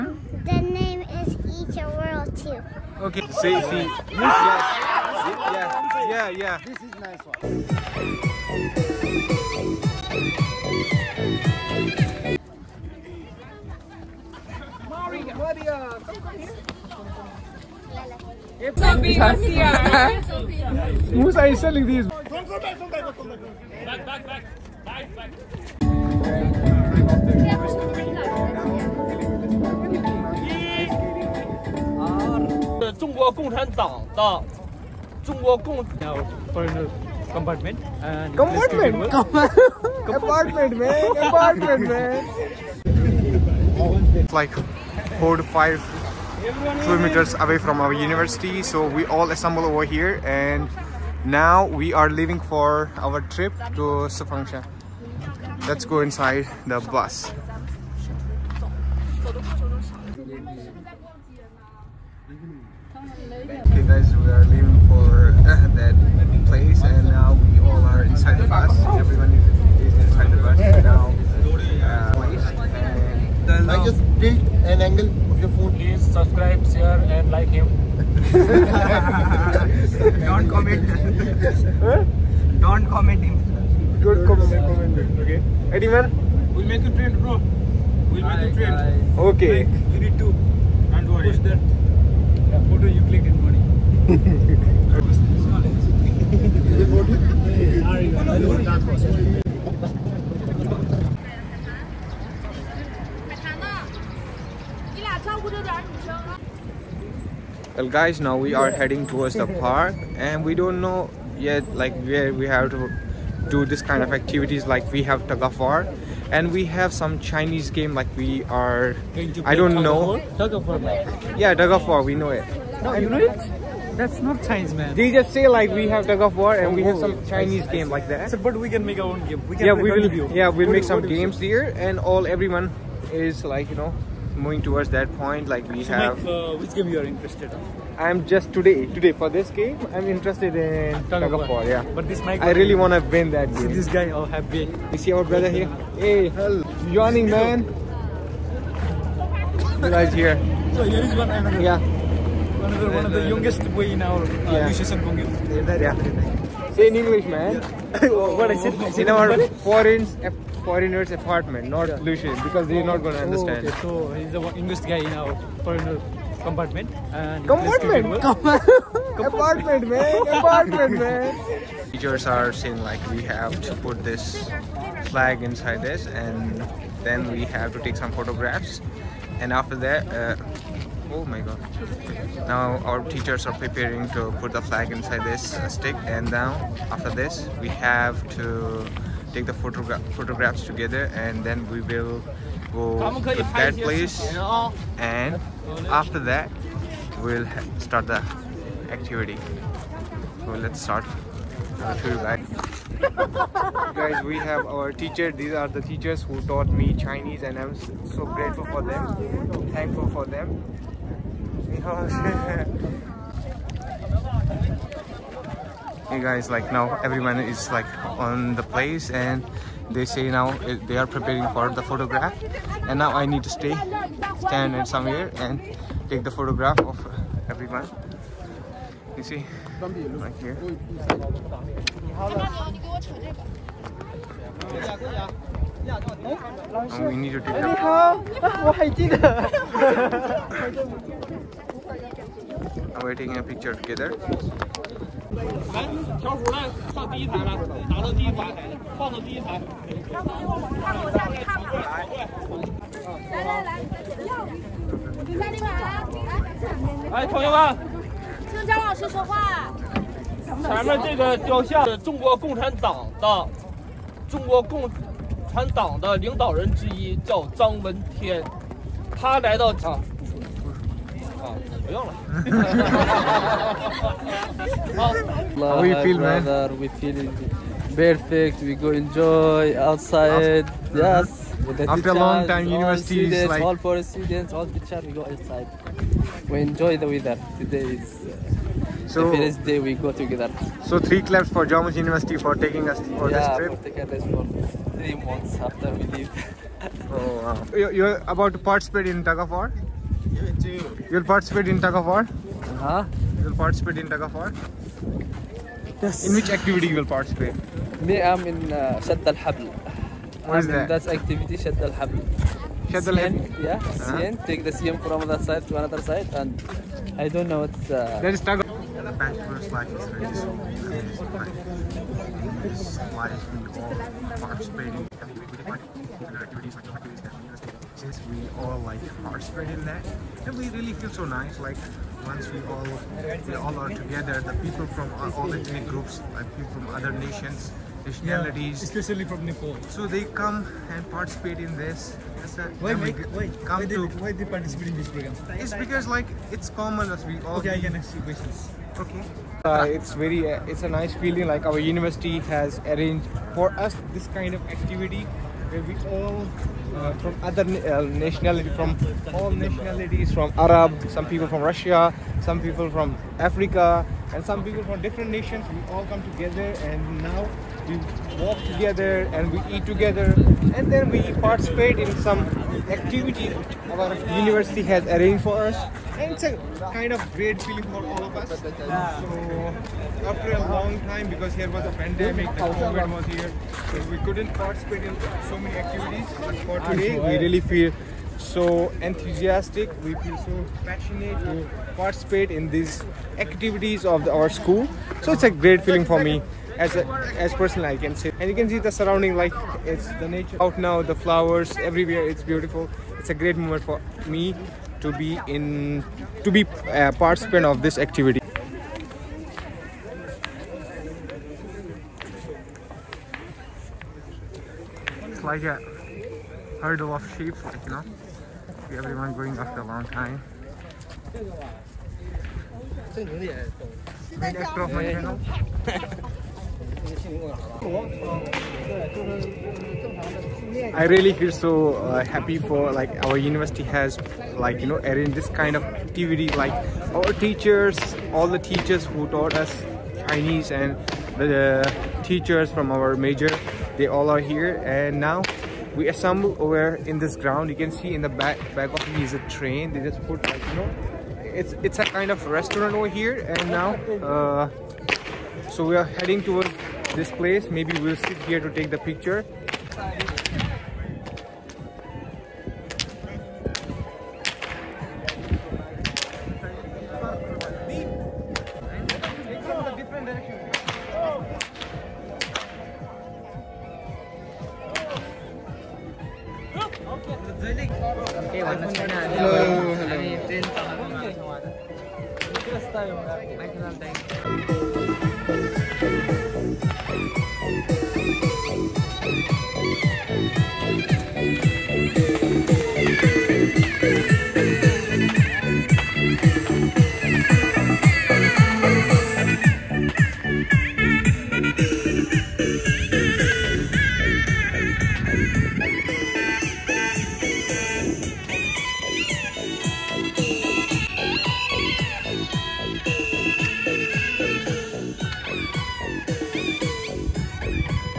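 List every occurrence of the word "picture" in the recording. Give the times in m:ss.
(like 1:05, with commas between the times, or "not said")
4:03, 7:38.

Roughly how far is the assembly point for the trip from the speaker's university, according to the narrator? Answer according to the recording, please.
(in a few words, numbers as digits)
4 to 5 kilometers.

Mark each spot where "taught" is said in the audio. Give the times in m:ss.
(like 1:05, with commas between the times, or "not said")
3:26, 7:19.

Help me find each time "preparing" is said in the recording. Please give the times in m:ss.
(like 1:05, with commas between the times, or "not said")
3:03, 3:41.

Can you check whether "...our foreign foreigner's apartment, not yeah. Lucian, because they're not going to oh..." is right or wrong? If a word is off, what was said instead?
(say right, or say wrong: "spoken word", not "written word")
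right.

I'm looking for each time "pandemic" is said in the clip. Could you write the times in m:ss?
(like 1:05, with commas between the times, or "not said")
6:22.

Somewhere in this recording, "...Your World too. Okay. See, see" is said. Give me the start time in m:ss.
0:01.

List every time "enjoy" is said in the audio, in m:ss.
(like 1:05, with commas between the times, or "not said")
4:38, 4:46.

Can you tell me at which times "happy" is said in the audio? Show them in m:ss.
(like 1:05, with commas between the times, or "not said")
2:24, 7:12.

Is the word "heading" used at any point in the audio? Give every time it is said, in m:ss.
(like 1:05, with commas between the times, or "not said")
1:48, 7:36.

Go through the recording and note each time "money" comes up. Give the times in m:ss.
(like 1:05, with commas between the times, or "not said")
1:39.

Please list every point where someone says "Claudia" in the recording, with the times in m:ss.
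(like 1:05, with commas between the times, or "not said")
0:15.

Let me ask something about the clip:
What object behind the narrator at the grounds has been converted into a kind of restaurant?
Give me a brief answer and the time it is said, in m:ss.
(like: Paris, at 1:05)
A train, at 7:29.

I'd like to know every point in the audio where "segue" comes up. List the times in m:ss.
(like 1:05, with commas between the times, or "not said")
not said.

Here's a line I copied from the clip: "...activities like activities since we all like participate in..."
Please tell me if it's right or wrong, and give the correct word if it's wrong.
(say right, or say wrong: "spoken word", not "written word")
right.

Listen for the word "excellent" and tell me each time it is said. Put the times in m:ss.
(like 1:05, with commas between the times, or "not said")
not said.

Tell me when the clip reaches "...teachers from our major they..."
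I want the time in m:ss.
7:22.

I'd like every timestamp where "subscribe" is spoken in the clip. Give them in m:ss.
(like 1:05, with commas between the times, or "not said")
1:16.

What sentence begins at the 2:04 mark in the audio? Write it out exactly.
They just say like we have tug of war and we have some oh, Chinese game like that.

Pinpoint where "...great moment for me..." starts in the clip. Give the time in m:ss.
6:43.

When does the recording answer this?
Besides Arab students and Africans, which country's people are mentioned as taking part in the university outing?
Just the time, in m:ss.
6:01.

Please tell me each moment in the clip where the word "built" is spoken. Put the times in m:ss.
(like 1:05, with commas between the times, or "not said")
1:14.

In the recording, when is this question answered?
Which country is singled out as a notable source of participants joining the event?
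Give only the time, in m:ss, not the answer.
5:39.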